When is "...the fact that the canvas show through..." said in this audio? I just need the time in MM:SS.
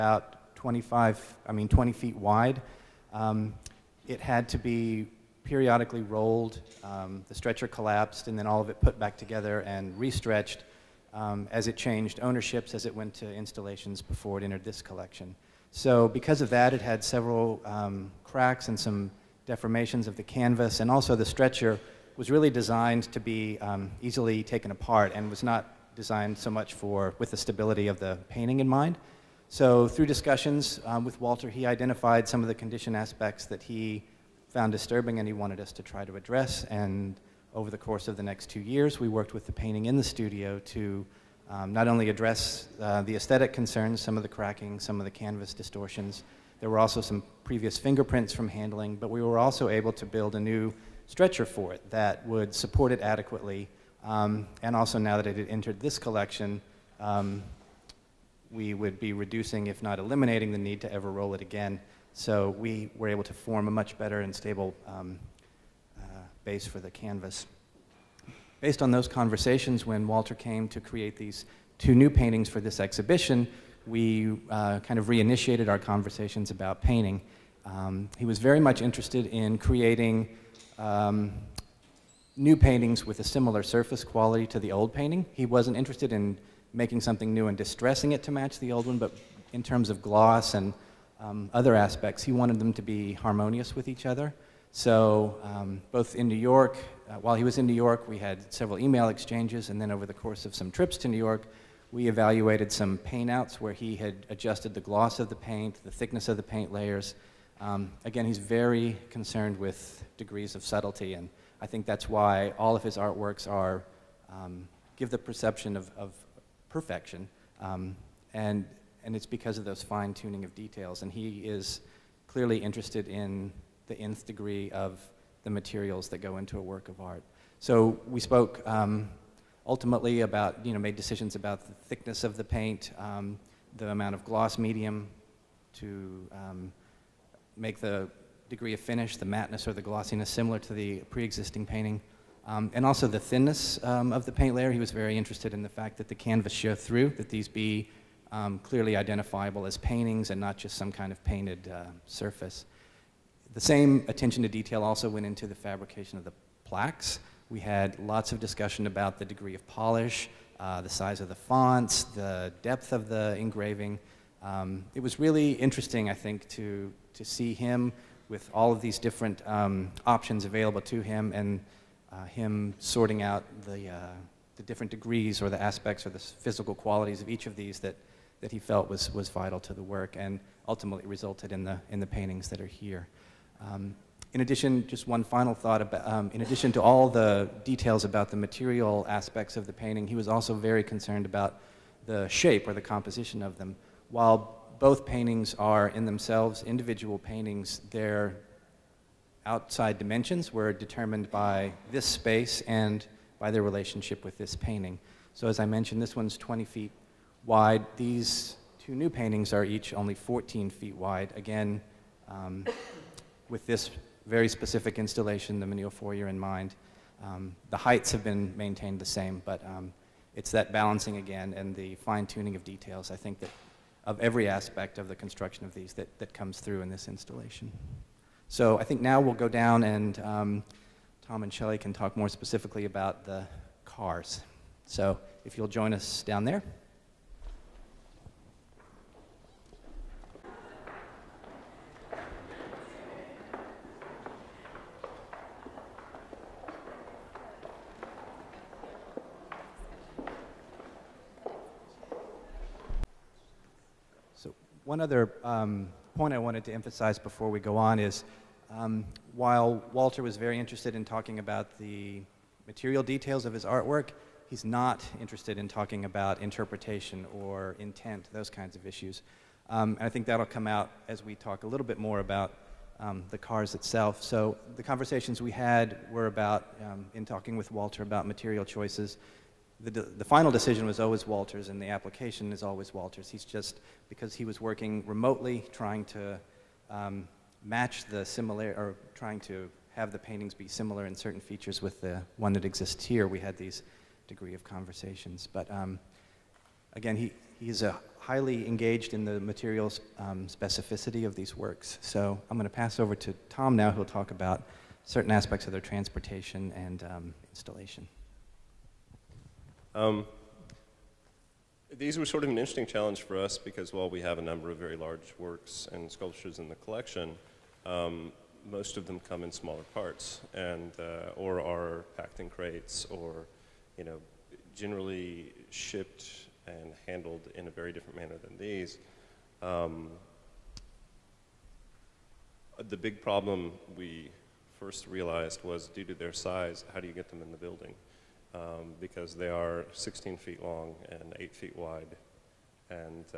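02:25.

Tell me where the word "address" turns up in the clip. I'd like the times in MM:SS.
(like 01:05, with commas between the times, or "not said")
00:36, 00:42.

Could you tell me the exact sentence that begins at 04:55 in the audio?
But um, again, he, he's a highly engaged in the material um, specificity of these works.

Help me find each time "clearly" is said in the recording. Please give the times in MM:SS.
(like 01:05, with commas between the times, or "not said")
02:02, 02:28.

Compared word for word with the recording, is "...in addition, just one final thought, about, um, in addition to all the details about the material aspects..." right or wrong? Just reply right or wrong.
right.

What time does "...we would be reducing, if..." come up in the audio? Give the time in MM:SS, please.
00:58.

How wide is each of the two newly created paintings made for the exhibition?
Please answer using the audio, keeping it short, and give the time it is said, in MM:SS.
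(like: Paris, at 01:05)
14 feet, at 03:30.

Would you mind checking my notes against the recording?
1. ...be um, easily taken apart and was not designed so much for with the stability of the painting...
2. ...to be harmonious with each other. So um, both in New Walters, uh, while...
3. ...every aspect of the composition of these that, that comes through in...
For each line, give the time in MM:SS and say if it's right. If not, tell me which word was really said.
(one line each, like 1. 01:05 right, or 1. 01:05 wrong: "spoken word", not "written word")
1. 00:23 right
2. 01:32 wrong: "York", not "Walters"
3. 03:44 wrong: "construction", not "composition".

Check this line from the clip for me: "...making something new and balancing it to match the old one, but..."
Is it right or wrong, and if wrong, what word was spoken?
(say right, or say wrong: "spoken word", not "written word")
wrong: "distressing", not "balancing".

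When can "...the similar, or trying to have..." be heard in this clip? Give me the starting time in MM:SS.
04:48.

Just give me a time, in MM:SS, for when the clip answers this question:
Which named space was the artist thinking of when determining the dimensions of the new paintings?
03:35.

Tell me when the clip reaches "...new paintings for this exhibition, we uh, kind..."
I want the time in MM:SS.
01:11.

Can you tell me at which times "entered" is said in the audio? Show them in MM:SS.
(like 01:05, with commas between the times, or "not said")
00:14, 00:55.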